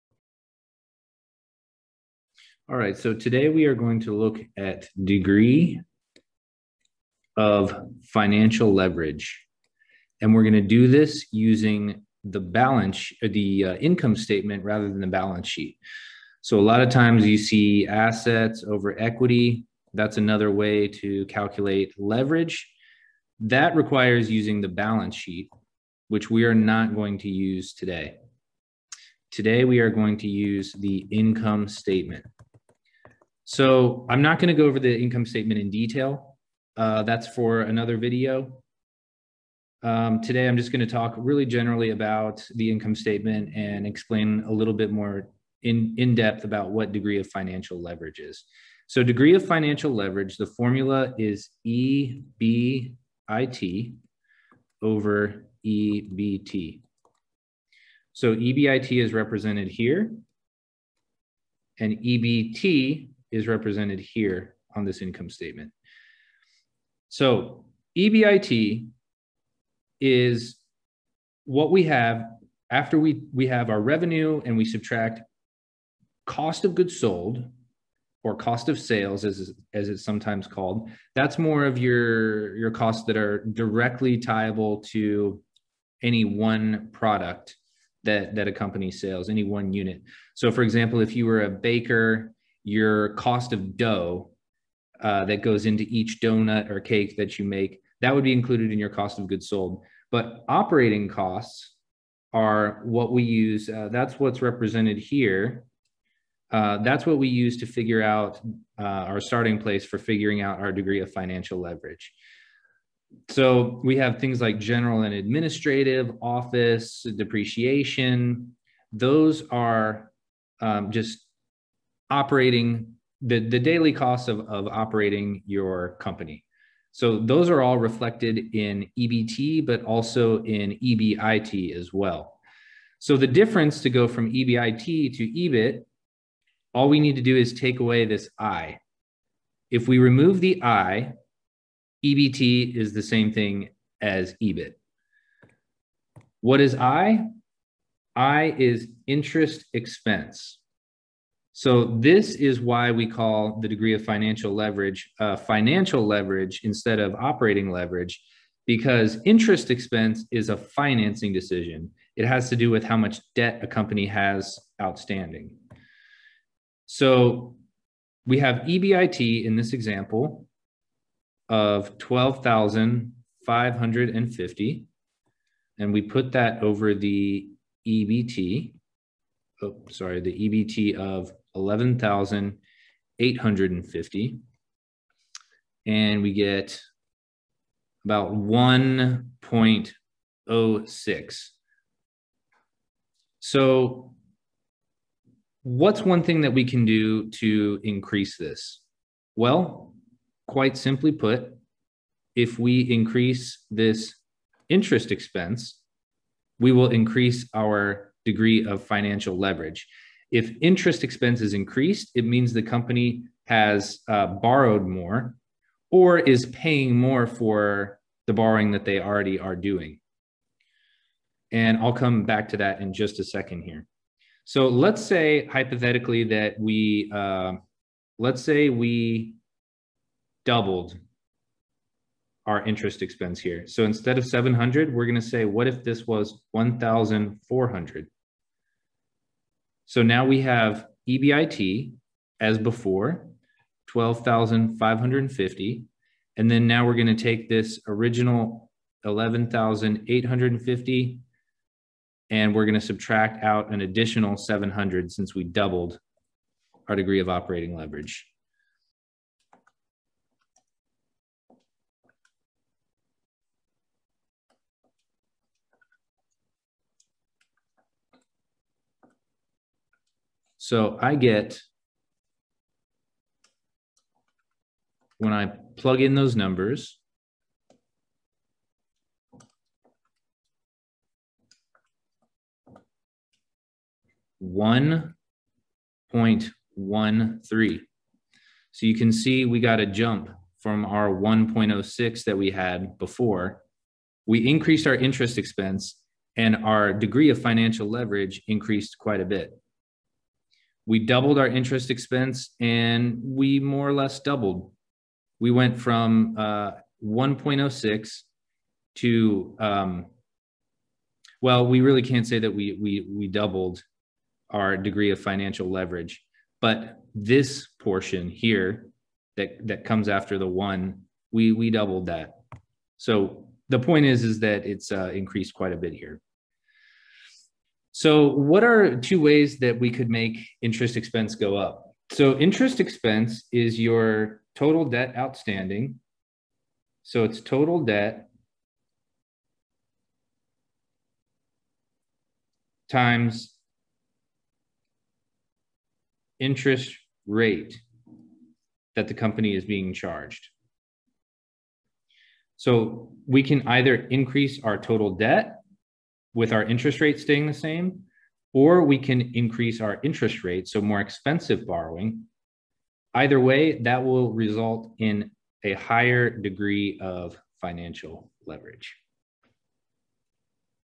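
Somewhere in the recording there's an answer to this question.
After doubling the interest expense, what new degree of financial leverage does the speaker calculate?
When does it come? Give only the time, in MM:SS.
04:44.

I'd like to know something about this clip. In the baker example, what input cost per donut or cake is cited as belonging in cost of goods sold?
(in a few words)
Dough.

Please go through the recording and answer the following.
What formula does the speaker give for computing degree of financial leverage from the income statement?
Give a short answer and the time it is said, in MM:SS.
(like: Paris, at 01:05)
EBIT over EBT, at 00:51.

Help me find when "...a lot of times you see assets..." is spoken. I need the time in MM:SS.
00:16.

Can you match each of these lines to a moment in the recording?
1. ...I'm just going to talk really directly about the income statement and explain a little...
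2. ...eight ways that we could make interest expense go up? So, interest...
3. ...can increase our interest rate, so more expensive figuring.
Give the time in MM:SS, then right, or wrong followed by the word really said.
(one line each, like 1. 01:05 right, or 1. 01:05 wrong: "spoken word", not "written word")
1. 00:40 wrong: "generally", not "directly"
2. 05:28 wrong: "two", not "eight"
3. 05:58 wrong: "borrowing", not "figuring".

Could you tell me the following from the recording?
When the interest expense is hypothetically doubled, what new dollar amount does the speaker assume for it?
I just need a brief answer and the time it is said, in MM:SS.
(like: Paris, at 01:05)
1,400, at 03:56.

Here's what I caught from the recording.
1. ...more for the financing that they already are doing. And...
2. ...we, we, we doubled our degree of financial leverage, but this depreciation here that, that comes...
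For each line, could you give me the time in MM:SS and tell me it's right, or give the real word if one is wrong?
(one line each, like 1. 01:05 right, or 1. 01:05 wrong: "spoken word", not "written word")
1. 03:36 wrong: "borrowing", not "financing"
2. 05:12 wrong: "portion", not "depreciation".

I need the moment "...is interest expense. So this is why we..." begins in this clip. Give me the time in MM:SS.
02:28.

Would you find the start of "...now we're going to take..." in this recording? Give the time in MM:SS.
04:06.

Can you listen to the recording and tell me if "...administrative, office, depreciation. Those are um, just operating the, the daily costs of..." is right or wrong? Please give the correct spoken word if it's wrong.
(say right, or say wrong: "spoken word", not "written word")
right.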